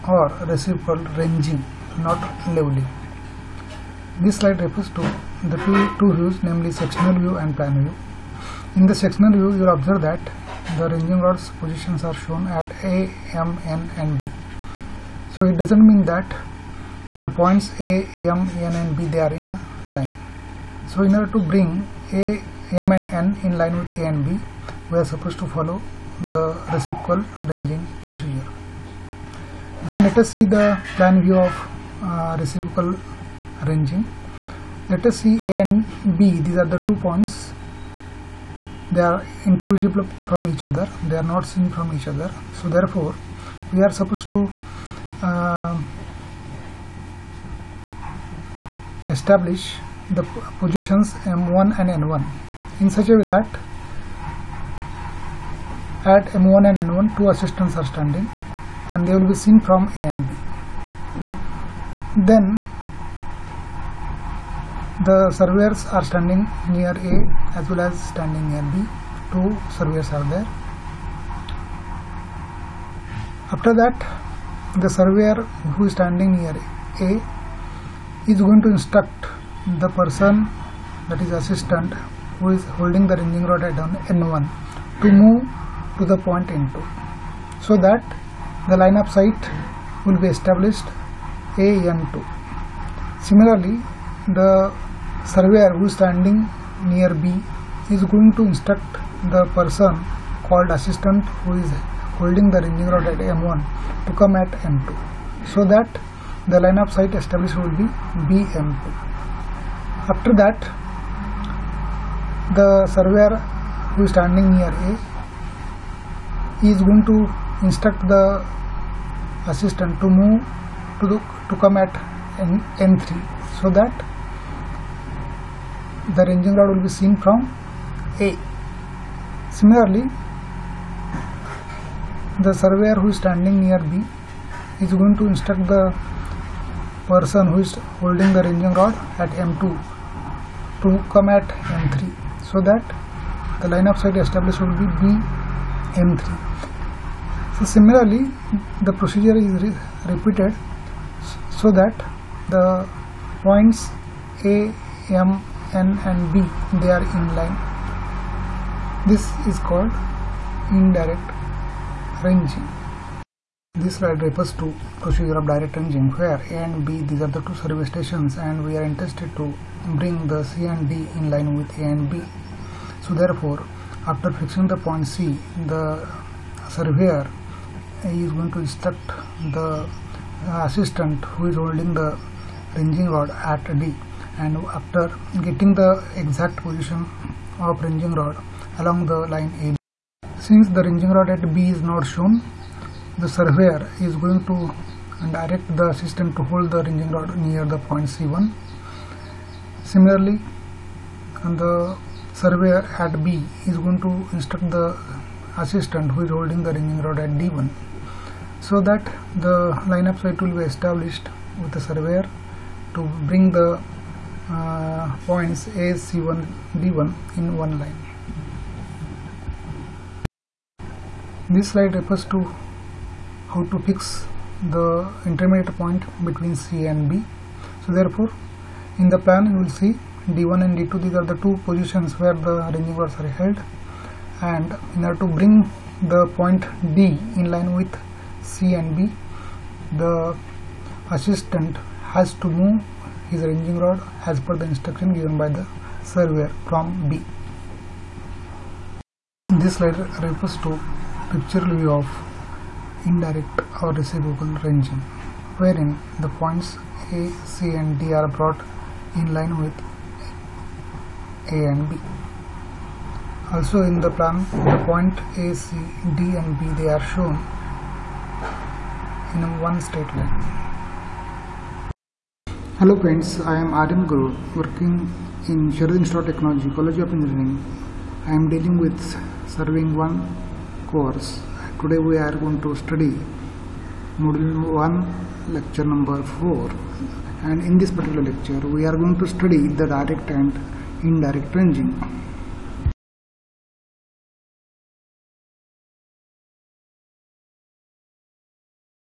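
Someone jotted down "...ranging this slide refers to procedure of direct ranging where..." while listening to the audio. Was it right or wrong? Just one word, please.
right.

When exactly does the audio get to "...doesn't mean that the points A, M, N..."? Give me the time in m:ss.
0:15.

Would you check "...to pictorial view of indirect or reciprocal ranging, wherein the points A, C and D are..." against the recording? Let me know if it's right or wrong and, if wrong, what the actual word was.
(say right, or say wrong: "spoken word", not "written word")
right.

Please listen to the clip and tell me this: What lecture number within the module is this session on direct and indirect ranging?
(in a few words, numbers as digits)
4.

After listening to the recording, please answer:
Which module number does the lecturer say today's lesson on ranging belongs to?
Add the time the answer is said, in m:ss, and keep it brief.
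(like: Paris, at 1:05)
1, at 4:44.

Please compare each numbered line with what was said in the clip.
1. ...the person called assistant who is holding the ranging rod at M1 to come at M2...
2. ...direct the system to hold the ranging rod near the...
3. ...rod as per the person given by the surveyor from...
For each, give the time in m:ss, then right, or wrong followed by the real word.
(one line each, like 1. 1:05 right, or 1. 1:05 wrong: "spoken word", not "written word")
1. 1:39 right
2. 3:15 right
3. 4:03 wrong: "instruction", not "person".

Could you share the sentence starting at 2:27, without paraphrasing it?
So similarly the procedure is re repeated so that the points A, M N and B they are in line.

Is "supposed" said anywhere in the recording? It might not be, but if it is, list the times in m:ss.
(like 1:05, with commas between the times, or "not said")
0:25, 0:43.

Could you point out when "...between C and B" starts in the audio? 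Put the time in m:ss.
3:46.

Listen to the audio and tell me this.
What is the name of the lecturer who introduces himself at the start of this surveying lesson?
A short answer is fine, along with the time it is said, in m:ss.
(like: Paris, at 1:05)
Adam Guru, at 4:33.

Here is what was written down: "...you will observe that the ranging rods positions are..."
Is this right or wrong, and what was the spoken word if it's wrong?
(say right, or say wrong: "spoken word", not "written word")
right.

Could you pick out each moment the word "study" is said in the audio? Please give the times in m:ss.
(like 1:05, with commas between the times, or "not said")
4:42, 4:49.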